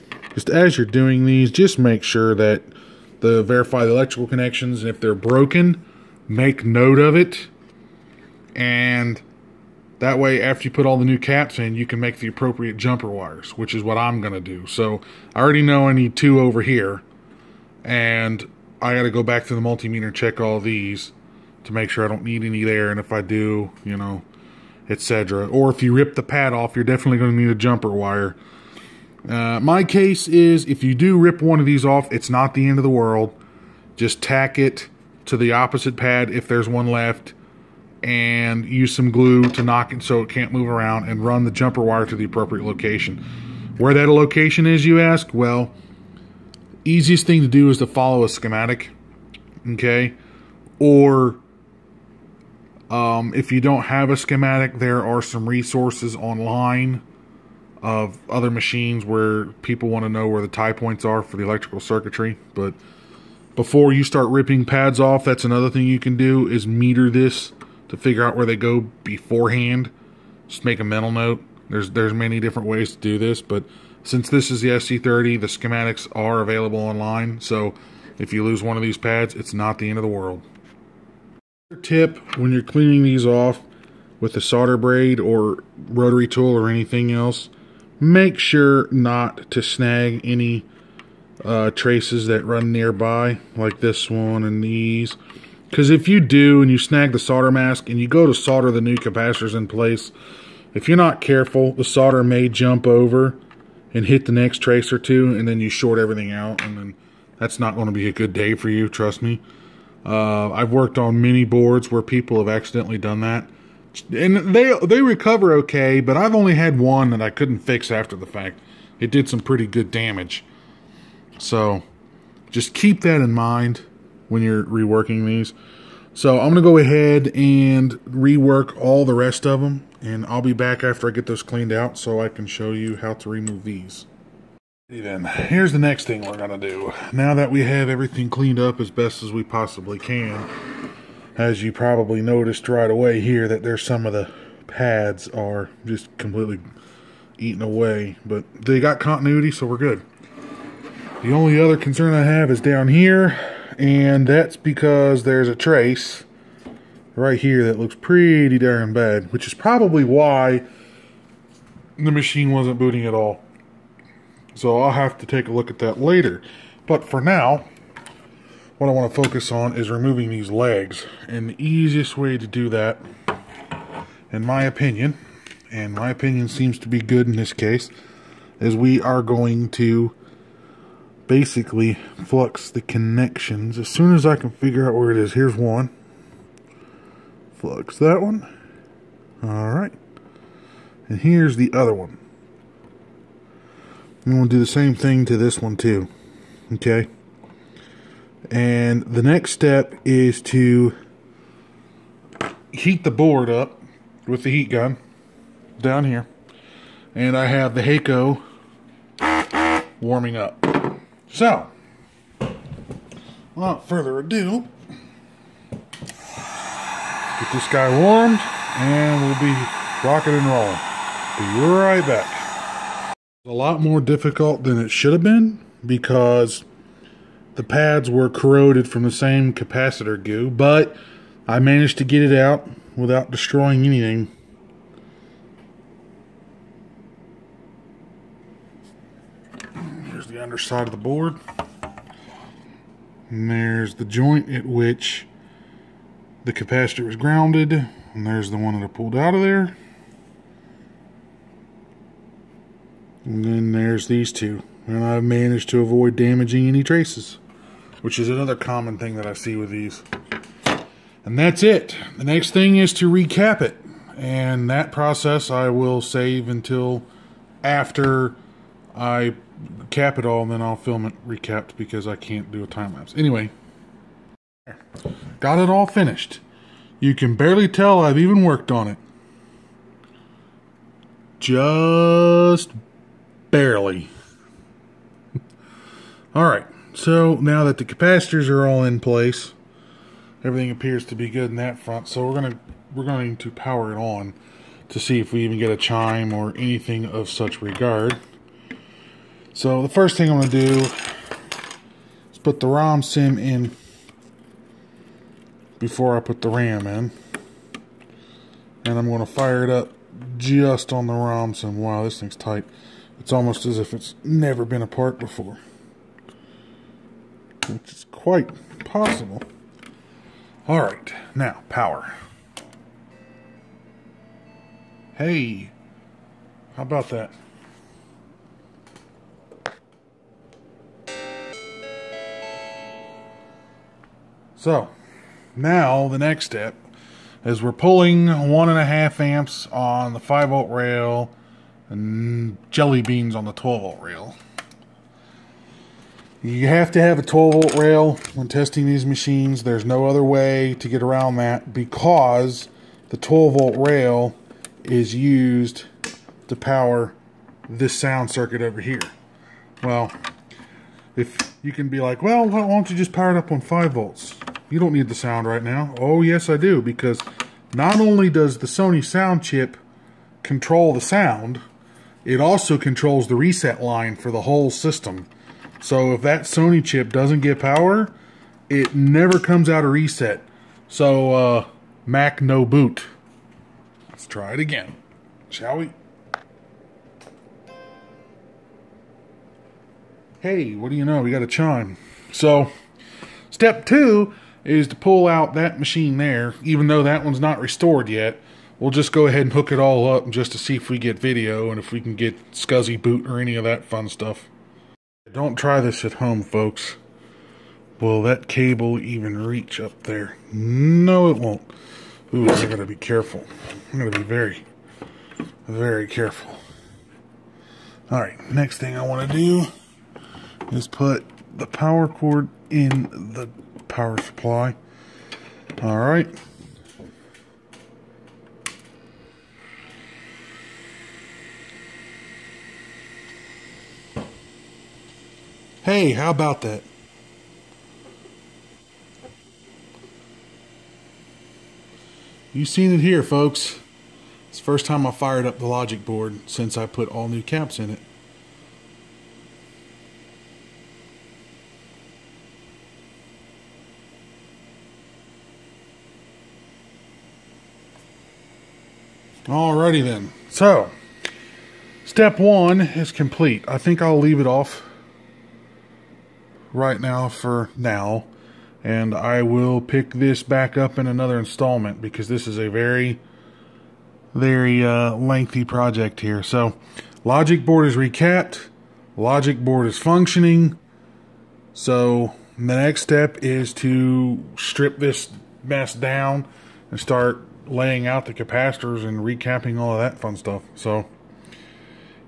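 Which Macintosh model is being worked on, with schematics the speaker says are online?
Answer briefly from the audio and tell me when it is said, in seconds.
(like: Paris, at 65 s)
SE30, at 74 s.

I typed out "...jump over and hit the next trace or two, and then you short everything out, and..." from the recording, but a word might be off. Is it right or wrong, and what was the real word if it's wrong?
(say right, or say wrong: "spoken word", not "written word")
right.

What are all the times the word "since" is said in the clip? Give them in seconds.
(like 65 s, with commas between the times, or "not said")
74 s, 446 s.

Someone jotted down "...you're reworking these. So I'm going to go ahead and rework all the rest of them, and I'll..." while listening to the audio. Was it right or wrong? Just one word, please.
right.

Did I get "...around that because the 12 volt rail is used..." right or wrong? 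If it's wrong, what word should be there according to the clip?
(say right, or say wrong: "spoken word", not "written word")
right.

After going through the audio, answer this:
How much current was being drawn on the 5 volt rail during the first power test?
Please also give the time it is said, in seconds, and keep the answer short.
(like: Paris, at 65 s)
1.5 amps, at 338 s.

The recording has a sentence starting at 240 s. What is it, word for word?
Here's the underside of the board.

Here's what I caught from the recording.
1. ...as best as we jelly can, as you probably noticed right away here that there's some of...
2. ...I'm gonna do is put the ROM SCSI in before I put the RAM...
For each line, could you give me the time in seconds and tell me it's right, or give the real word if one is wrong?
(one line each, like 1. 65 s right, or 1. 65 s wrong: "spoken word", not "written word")
1. 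138 s wrong: "possibly", not "jelly"
2. 300 s wrong: "SIMM", not "SCSI".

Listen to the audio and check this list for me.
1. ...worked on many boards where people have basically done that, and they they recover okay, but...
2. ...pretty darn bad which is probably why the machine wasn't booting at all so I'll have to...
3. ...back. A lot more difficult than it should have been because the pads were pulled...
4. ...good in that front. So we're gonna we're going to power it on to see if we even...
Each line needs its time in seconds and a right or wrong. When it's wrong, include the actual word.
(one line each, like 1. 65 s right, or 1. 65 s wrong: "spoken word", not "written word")
1. 110 s wrong: "accidentally", not "basically"
2. 157 s right
3. 222 s wrong: "corroded", not "pulled"
4. 291 s right.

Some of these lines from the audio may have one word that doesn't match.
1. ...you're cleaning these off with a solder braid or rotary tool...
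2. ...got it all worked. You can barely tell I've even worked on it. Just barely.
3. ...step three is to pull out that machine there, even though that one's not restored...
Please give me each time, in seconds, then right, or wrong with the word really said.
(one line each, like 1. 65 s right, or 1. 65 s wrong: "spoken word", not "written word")
1. 82 s right
2. 275 s wrong: "finished", not "worked"
3. 393 s wrong: "two", not "three".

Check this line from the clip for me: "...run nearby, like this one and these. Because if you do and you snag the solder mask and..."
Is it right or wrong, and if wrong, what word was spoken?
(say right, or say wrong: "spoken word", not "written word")
right.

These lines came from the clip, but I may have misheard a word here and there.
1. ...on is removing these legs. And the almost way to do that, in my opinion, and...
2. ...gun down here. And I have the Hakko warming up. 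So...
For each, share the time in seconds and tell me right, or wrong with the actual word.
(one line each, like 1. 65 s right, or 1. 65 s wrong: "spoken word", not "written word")
1. 169 s wrong: "easiest", not "almost"
2. 204 s right.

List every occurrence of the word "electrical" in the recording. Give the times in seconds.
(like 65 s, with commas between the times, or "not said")
3 s, 61 s.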